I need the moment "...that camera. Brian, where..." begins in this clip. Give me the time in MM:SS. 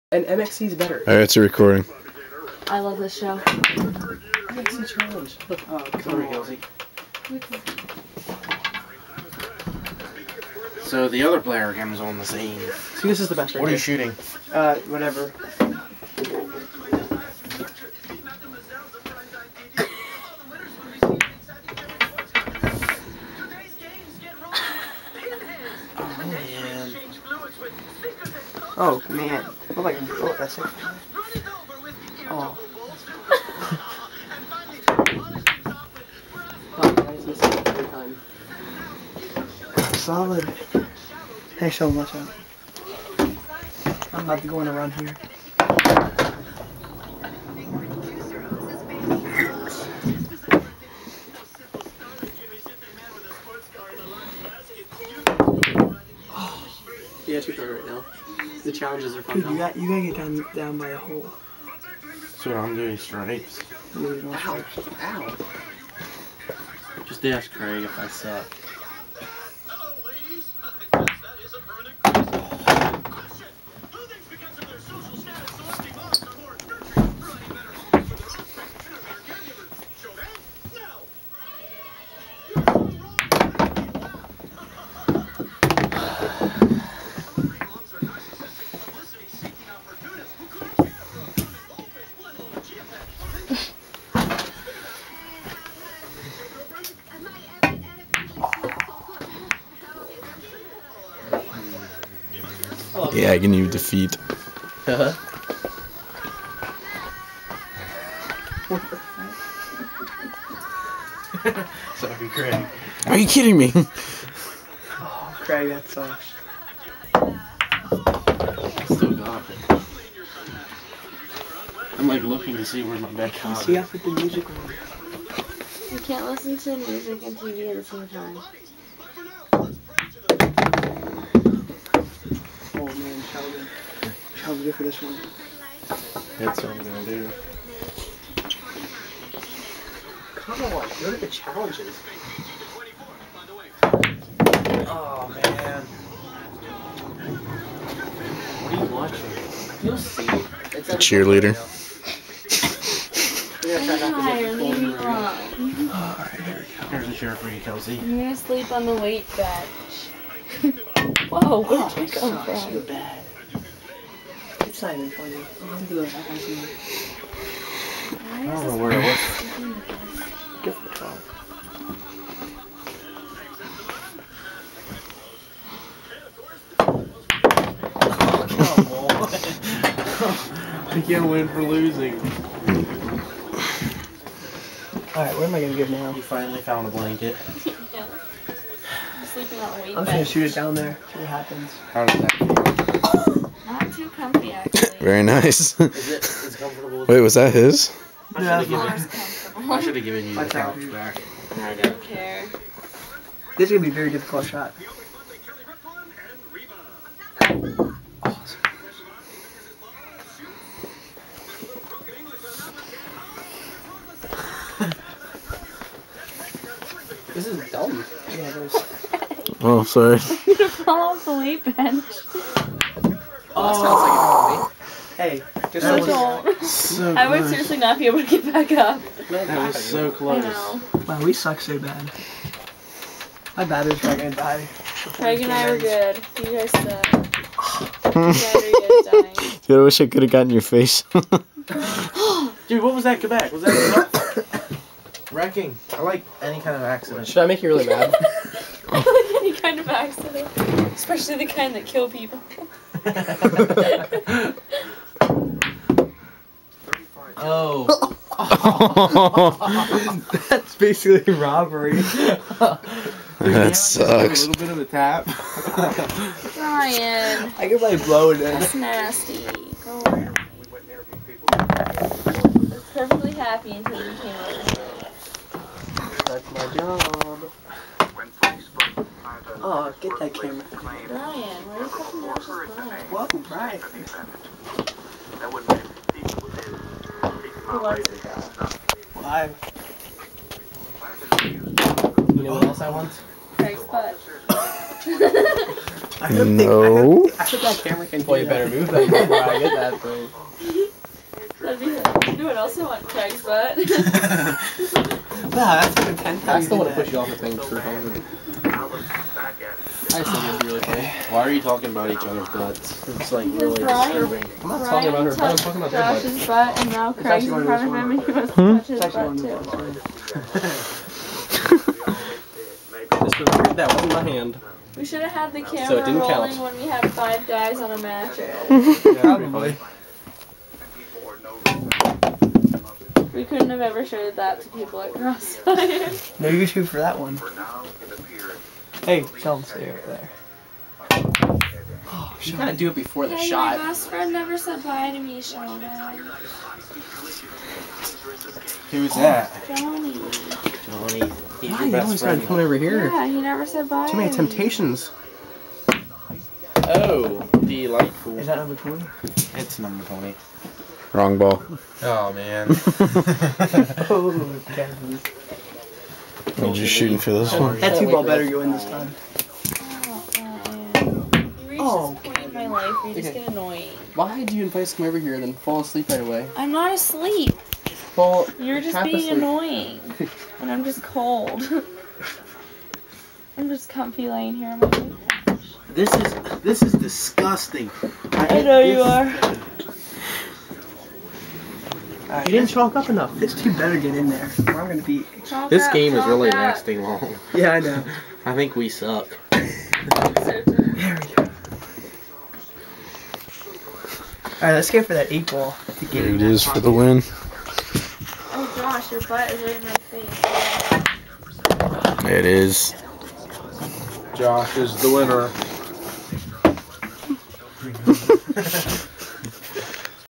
04:40.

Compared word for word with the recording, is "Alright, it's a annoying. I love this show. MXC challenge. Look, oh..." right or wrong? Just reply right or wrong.
wrong.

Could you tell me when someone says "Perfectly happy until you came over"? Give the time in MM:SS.
04:32.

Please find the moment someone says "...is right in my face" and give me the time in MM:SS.
06:49.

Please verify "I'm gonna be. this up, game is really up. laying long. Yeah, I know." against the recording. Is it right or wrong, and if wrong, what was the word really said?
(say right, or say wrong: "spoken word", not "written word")
wrong: "lasting", not "laying".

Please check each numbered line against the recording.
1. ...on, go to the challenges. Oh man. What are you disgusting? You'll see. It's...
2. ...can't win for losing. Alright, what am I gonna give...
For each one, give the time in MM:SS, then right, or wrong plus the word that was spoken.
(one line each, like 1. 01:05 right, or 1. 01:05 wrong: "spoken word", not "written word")
1. 02:20 wrong: "watching", not "disgusting"
2. 03:01 right.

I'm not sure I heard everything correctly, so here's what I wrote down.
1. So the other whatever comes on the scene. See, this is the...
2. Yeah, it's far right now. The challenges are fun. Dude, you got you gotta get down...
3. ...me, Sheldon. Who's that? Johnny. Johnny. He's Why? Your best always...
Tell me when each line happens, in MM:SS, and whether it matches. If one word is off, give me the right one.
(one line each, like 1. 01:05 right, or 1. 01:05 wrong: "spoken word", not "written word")
1. 00:10 wrong: "player", not "whatever"
2. 00:57 right
3. 05:45 right.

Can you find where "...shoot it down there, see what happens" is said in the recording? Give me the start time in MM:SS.
03:10.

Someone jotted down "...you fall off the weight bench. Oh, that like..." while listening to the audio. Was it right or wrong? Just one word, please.
right.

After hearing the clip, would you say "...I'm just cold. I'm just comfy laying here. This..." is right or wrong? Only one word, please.
right.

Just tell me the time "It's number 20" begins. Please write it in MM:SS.
05:59.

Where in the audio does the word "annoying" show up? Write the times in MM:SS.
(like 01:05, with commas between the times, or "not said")
06:13, 06:19.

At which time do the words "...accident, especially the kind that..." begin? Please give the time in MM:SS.
04:09.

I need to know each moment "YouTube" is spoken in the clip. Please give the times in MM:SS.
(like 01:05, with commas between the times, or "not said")
05:36.